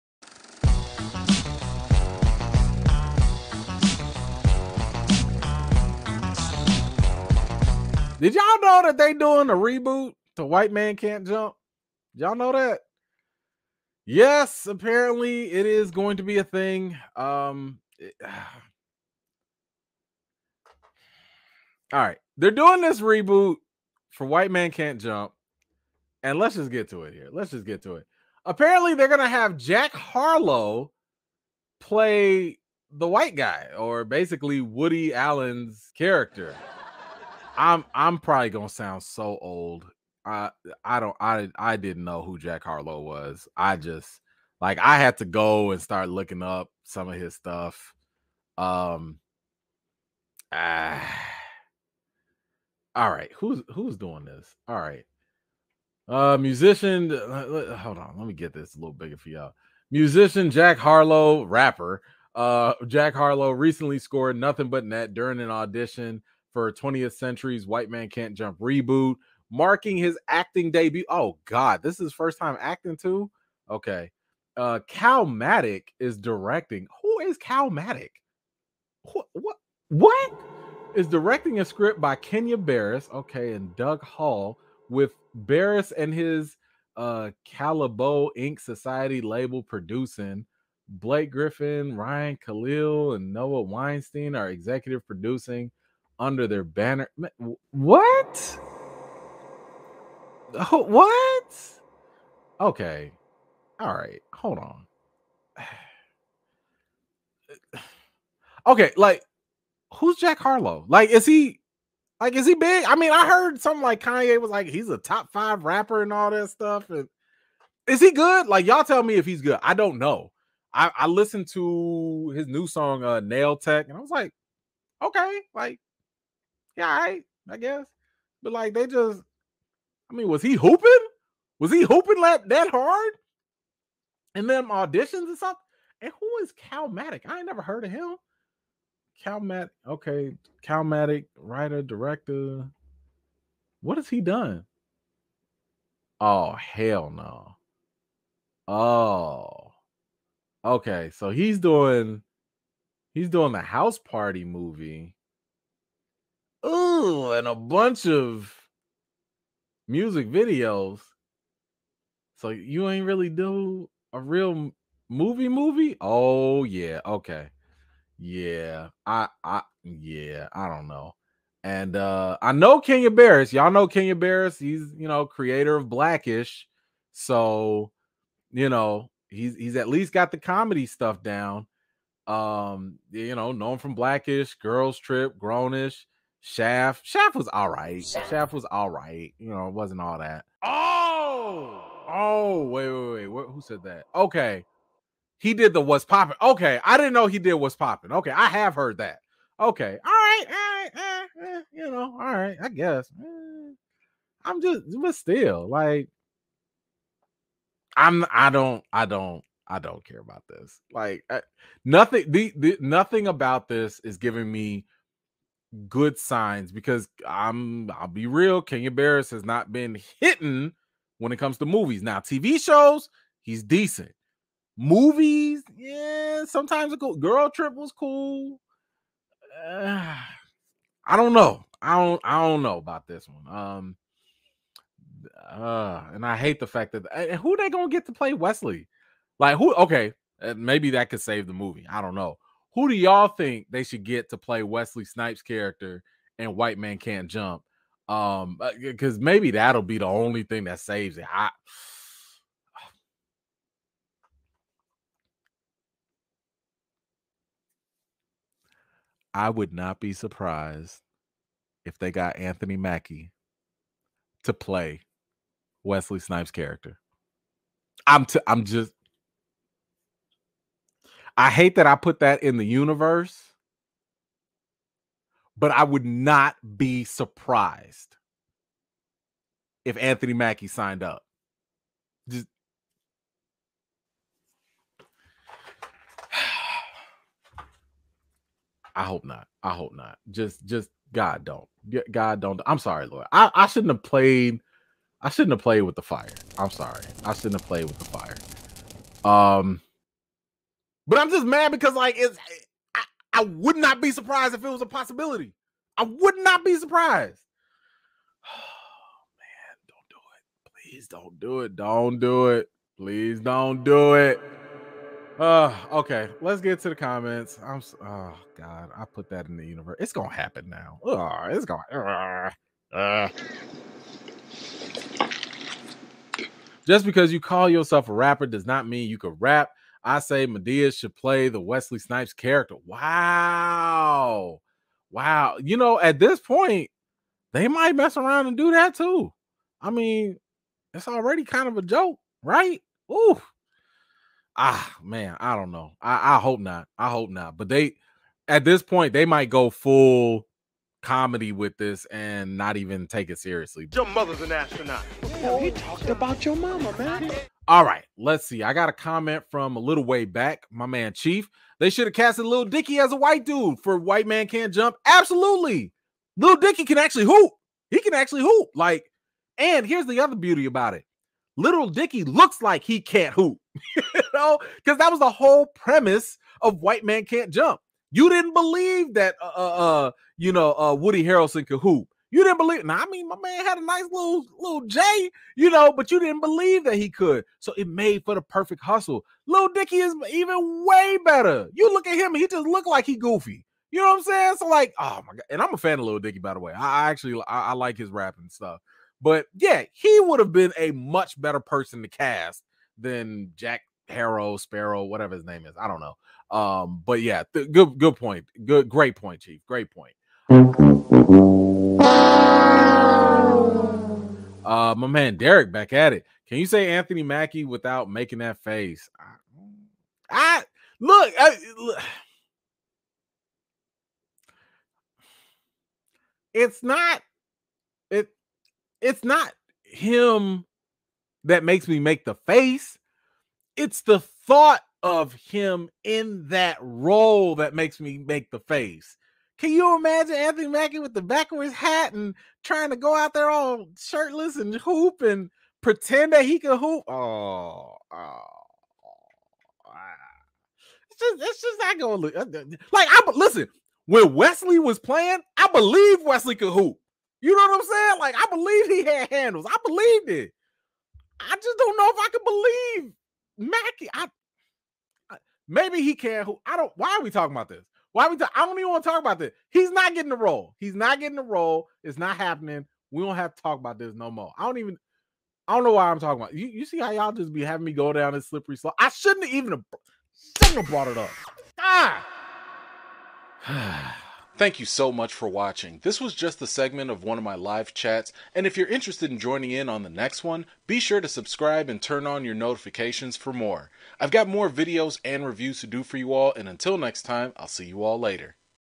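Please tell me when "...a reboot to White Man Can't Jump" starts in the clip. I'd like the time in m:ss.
0:09.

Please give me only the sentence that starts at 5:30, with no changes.
I say Madea should play the Wesley Snipes character.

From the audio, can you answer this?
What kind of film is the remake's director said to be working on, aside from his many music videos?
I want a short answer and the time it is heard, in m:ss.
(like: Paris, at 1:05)
house party movie, at 2:33.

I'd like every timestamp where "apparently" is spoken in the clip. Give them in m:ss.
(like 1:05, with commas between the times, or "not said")
0:14, 0:28.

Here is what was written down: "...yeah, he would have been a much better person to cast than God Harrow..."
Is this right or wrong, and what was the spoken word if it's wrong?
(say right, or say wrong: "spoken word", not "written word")
wrong: "Jack", not "God".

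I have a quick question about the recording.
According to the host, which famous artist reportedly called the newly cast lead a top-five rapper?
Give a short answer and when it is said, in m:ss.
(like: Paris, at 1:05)
Kanye, at 1:54.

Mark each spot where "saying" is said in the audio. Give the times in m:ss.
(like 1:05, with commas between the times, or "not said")
6:34, 7:37.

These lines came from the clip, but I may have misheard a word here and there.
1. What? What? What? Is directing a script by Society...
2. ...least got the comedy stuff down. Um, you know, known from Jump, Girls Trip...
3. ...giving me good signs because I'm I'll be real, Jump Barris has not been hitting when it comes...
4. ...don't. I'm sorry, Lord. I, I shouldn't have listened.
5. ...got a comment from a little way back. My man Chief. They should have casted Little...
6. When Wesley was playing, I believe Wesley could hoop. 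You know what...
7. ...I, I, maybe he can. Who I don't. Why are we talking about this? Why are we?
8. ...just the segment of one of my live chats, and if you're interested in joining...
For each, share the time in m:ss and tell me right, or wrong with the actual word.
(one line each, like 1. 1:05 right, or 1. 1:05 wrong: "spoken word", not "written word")
1. 1:19 wrong: "Kenya", not "Society"
2. 2:59 wrong: "Blackish", not "Jump"
3. 3:34 wrong: "Kenya", not "Jump"
4. 4:52 wrong: "played", not "listened"
5. 5:58 right
6. 7:34 right
7. 7:44 right
8. 8:06 right.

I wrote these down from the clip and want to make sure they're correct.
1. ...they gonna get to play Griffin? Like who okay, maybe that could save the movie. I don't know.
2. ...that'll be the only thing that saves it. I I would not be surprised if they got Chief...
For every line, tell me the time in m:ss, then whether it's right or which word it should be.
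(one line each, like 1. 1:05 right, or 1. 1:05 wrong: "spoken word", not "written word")
1. 3:57 wrong: "Wesley", not "Griffin"
2. 4:09 wrong: "Anthony", not "Chief".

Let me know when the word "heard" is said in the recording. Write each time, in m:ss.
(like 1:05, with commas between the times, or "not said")
1:53, 2:17, 3:18.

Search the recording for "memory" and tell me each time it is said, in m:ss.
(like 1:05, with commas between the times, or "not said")
not said.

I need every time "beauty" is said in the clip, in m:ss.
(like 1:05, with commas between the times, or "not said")
6:10.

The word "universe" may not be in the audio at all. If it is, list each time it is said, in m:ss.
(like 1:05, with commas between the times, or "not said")
4:32, 5:19.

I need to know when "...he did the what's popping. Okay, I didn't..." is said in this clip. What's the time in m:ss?
3:15.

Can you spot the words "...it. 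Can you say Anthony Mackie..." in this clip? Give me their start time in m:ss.
6:56.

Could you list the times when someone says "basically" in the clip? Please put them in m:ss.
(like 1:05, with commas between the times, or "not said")
0:34.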